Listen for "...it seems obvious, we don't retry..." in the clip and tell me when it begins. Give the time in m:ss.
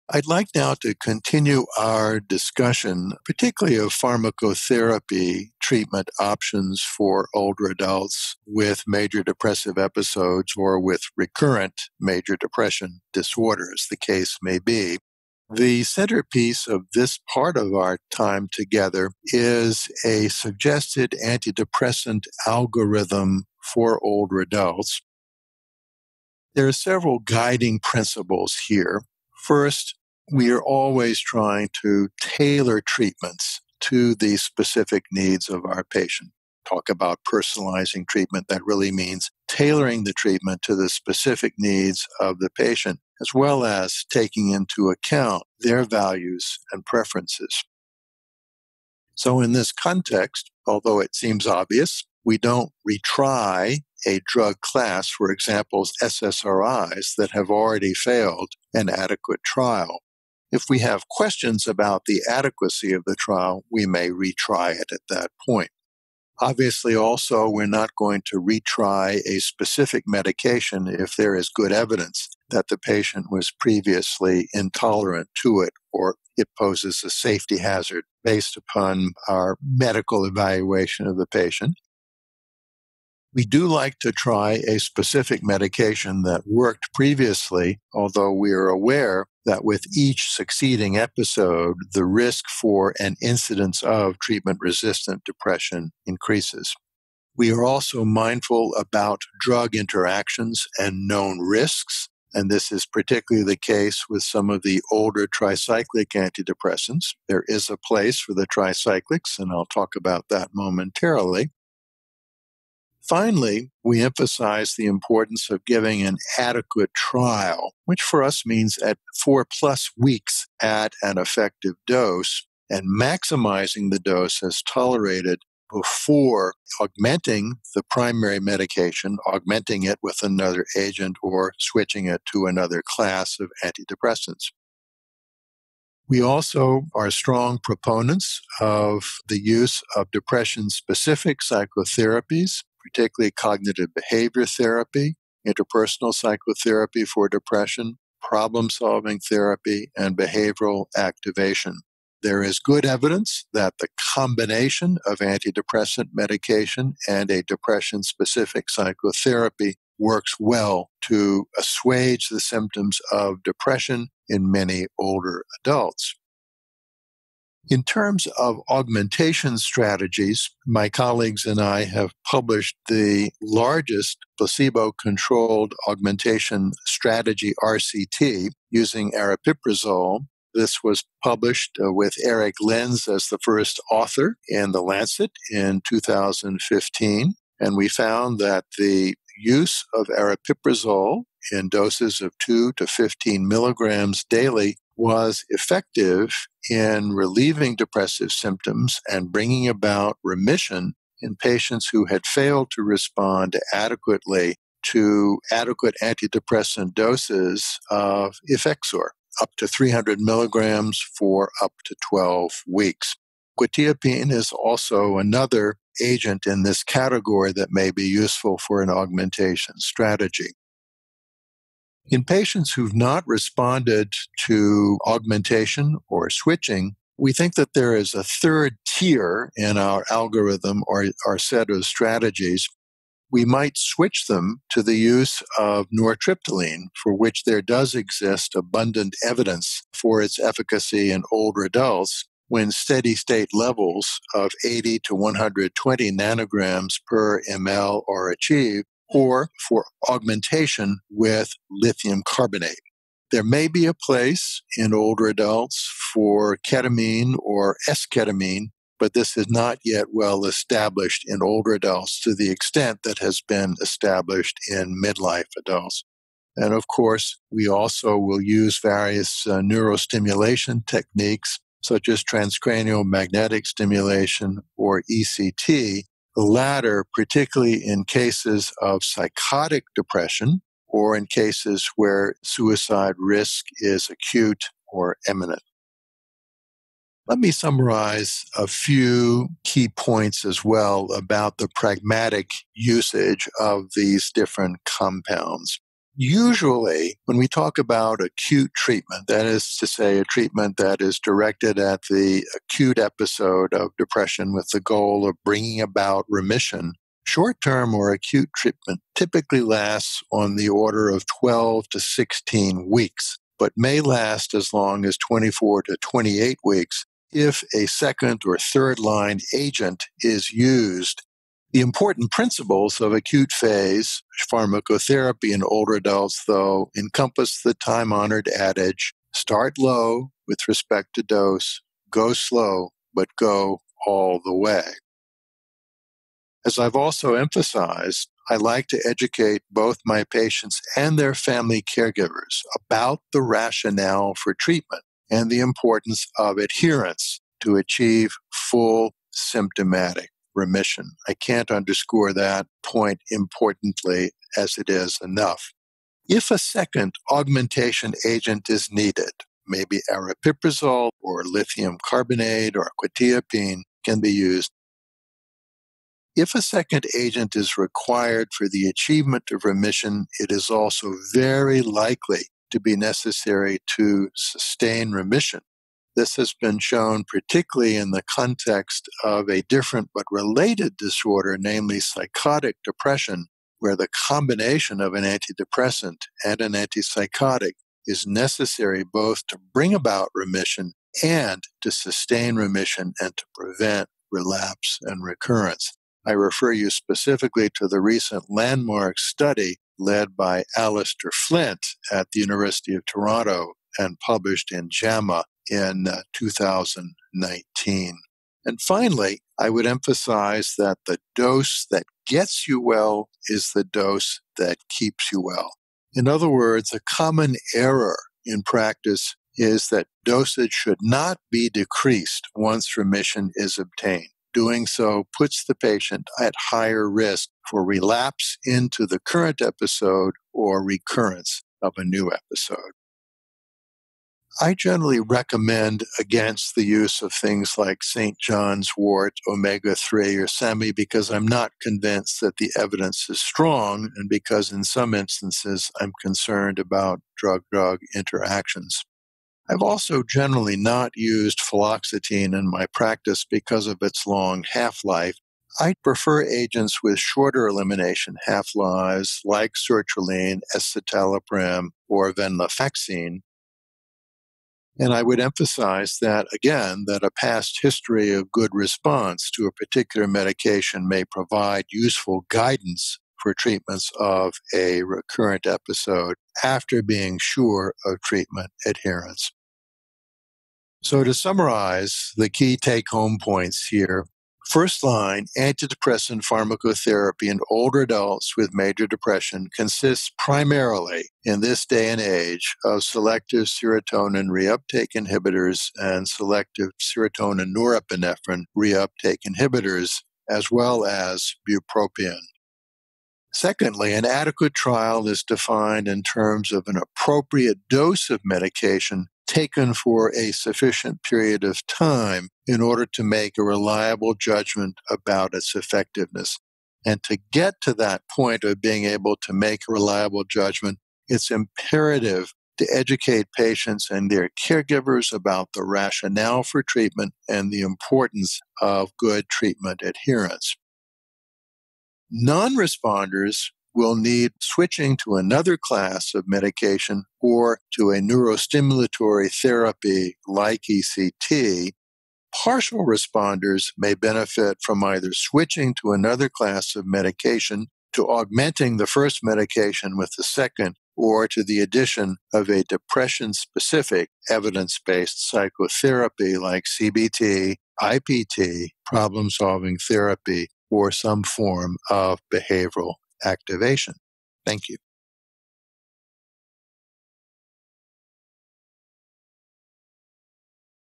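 0:51.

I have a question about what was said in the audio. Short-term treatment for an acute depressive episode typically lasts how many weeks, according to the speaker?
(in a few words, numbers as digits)
12 to 16 weeks.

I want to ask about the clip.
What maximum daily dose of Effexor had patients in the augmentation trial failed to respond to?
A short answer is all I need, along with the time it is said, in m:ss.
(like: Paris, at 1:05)
300 milligrams, at 3:29.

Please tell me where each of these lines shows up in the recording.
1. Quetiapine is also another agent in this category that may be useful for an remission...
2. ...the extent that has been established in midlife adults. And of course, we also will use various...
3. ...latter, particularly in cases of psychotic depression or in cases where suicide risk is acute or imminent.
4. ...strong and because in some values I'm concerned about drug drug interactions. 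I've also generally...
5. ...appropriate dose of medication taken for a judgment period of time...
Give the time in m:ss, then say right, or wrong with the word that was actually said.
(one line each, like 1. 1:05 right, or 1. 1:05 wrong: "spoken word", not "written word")
1. 3:33 wrong: "augmentation", not "remission"
2. 4:22 right
3. 4:36 right
4. 7:23 wrong: "instances", not "values"
5. 8:26 wrong: "sufficient", not "judgment".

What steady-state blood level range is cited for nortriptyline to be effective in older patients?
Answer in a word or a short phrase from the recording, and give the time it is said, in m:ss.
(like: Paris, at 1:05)
80 to 120 ng/ml, at 4:04.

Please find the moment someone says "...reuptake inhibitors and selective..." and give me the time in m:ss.
8:14.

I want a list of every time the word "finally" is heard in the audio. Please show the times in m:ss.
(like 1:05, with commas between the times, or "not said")
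1:53, 6:48.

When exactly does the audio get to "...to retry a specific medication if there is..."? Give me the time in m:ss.
1:08.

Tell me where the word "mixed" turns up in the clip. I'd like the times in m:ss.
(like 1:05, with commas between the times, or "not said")
not said.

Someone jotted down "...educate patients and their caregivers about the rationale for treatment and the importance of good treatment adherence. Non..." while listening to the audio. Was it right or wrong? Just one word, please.
right.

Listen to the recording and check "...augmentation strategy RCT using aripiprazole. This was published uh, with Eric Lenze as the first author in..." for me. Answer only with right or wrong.
right.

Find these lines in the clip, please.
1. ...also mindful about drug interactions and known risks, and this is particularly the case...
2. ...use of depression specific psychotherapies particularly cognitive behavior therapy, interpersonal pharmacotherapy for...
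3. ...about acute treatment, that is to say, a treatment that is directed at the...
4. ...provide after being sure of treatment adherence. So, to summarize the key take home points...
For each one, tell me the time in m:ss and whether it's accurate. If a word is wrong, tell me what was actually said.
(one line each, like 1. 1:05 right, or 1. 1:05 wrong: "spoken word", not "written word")
1. 1:37 right
2. 2:19 wrong: "psychotherapy", not "pharmacotherapy"
3. 4:57 right
4. 7:55 wrong: "episode", not "provide".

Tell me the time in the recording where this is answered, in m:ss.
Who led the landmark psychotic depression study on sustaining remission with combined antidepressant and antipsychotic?
6:40.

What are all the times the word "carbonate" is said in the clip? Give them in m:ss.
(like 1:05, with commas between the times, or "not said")
4:12, 6:02.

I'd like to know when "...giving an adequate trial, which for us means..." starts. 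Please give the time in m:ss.
1:55.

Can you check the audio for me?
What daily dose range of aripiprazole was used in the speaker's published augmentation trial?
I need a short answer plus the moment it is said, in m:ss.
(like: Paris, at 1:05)
2 to 15 milligrams, at 3:12.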